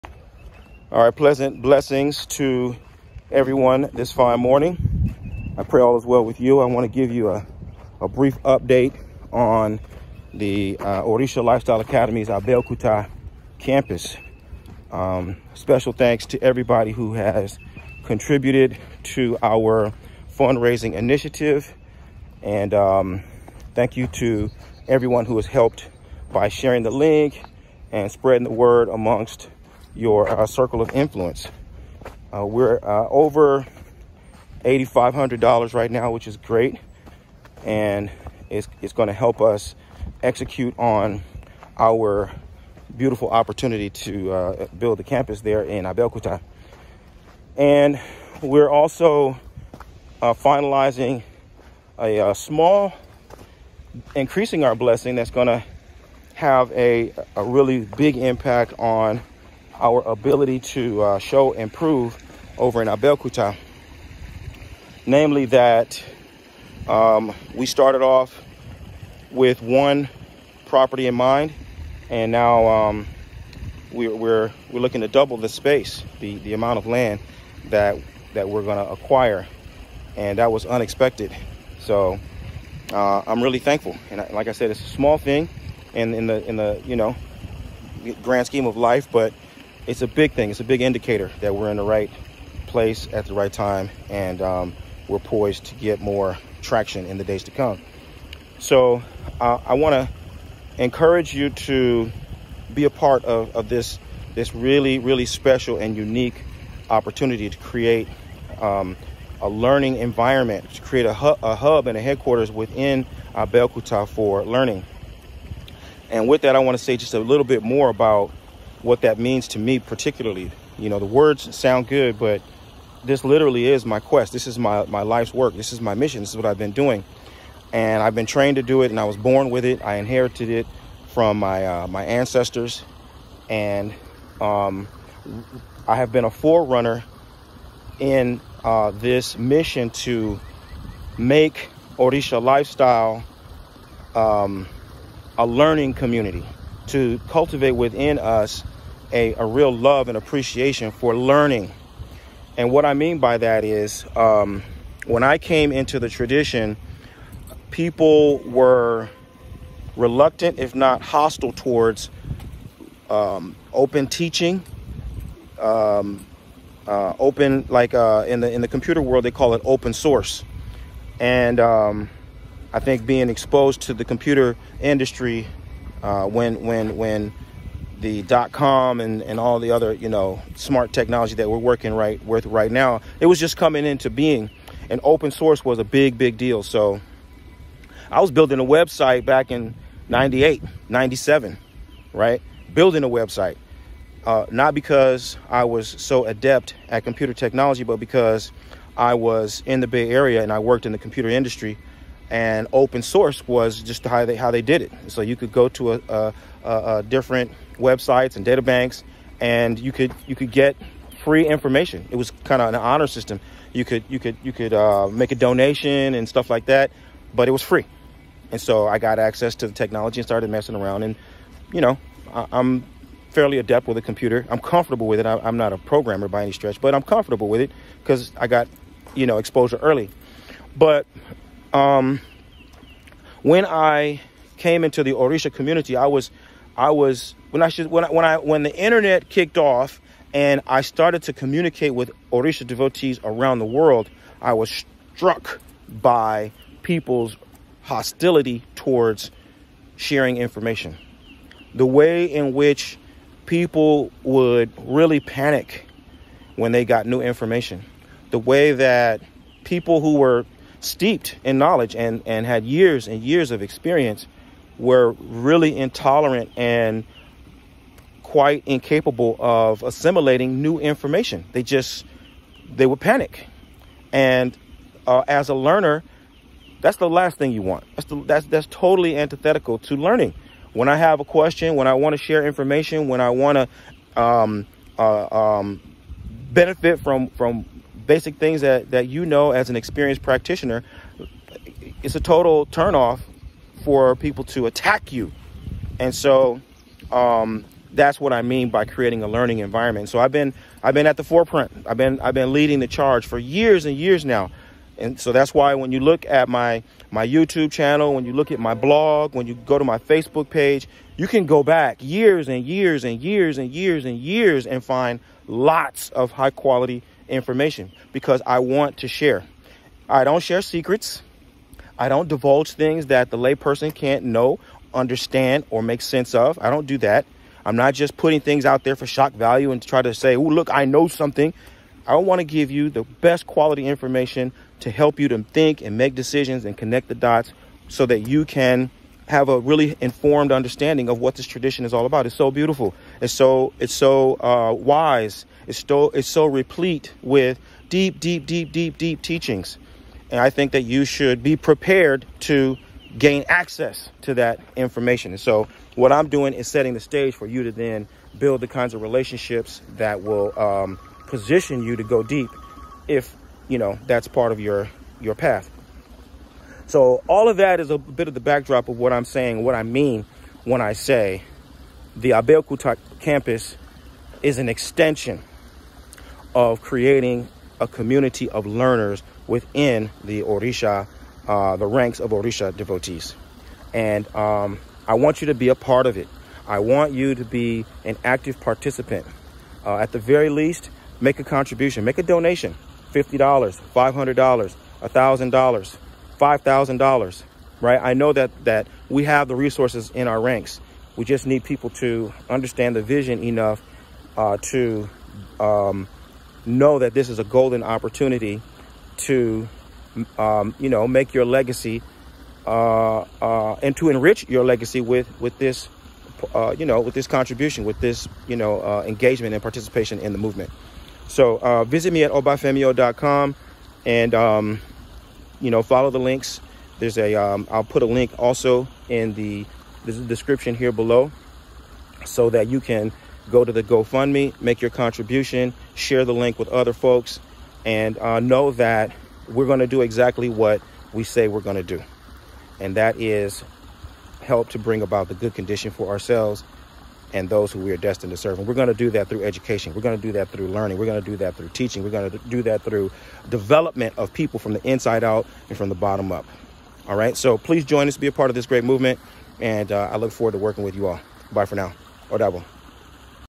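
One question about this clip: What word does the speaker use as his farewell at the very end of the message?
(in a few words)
Odabo.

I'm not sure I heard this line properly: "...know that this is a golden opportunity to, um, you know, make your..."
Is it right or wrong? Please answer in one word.
right.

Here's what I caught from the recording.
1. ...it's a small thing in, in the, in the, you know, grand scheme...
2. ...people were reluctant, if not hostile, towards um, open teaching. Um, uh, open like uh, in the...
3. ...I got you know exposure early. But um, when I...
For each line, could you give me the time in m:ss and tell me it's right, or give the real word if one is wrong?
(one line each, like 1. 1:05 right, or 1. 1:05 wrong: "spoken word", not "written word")
1. 1:24 right
2. 2:37 right
3. 3:48 right.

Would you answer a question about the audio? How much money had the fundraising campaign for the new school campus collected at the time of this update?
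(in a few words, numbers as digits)
over $8,500.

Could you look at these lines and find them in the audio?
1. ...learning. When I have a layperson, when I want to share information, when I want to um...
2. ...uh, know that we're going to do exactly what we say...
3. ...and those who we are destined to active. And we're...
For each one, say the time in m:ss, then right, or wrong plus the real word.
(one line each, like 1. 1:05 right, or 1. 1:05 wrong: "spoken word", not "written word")
1. 4:39 wrong: "question", not "layperson"
2. 7:18 right
3. 7:27 wrong: "serve", not "active".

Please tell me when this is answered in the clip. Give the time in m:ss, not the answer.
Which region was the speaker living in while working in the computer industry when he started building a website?
3:19.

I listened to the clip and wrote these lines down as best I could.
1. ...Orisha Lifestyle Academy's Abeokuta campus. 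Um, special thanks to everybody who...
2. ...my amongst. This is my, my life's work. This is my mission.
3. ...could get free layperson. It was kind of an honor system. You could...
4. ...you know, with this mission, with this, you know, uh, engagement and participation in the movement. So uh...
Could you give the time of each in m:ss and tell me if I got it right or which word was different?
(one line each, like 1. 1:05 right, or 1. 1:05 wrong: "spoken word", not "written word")
1. 0:11 right
2. 2:03 wrong: "quest", not "amongst"
3. 3:30 wrong: "information", not "layperson"
4. 6:56 wrong: "contribution", not "mission".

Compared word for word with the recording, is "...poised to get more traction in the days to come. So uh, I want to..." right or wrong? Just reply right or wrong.
right.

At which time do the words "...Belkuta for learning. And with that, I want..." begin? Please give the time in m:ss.
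1:53.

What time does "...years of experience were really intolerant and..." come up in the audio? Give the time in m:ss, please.
4:23.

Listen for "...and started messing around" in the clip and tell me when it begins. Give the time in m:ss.
3:40.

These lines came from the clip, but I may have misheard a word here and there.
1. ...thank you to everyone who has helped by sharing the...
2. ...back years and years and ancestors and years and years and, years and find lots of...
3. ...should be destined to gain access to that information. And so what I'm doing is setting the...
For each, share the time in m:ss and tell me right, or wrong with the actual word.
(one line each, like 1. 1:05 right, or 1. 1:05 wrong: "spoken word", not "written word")
1. 0:23 right
2. 5:11 wrong: "years", not "ancestors"
3. 5:51 wrong: "prepared", not "destined".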